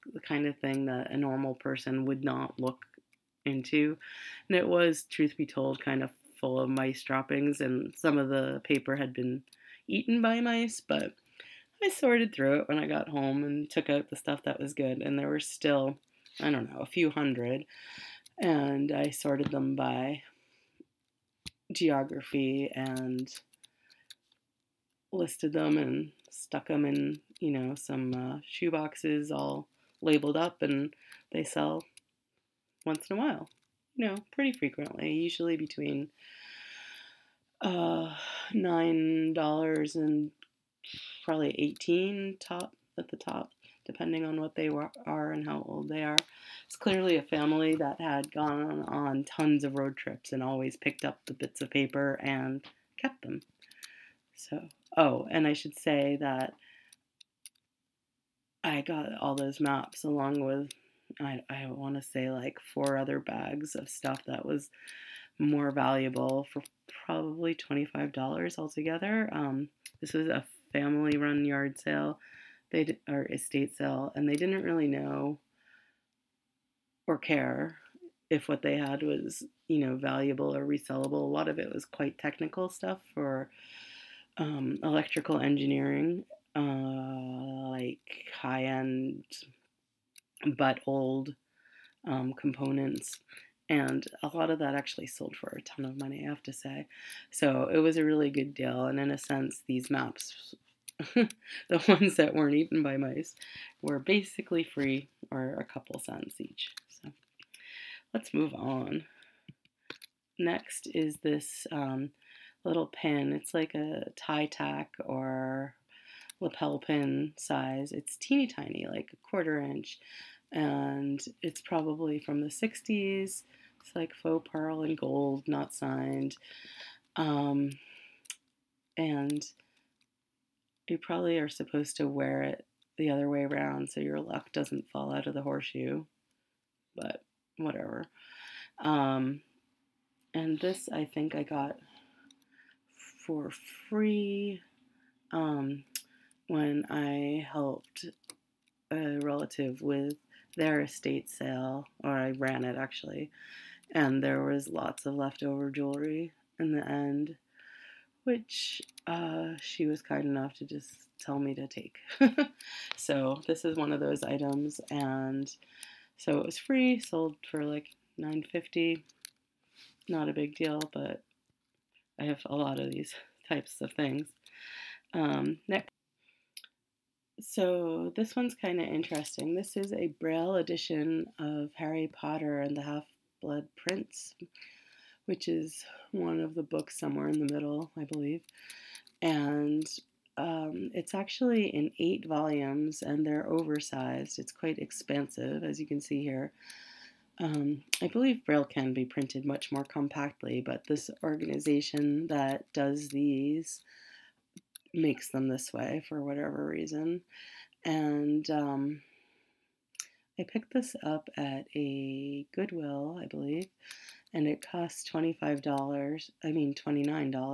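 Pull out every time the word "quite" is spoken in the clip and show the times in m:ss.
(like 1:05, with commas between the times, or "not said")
1:21, 3:14.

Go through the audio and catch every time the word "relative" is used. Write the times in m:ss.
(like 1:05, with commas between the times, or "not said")
2:29.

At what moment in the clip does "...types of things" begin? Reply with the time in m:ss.
2:53.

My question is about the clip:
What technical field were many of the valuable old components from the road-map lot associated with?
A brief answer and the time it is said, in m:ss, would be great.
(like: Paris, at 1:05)
electrical engineering, at 1:24.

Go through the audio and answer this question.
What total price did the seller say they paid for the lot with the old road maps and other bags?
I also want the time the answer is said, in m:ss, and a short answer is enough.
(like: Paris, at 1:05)
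$25, at 1:07.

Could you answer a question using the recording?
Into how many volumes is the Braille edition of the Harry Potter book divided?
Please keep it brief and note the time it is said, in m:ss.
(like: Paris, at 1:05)
8, at 3:11.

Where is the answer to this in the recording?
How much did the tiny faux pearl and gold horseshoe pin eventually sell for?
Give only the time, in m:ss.
2:48.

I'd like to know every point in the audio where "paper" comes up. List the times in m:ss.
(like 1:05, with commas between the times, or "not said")
0:08, 0:51.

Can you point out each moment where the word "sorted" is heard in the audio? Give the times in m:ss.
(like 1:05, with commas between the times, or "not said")
0:11, 0:19.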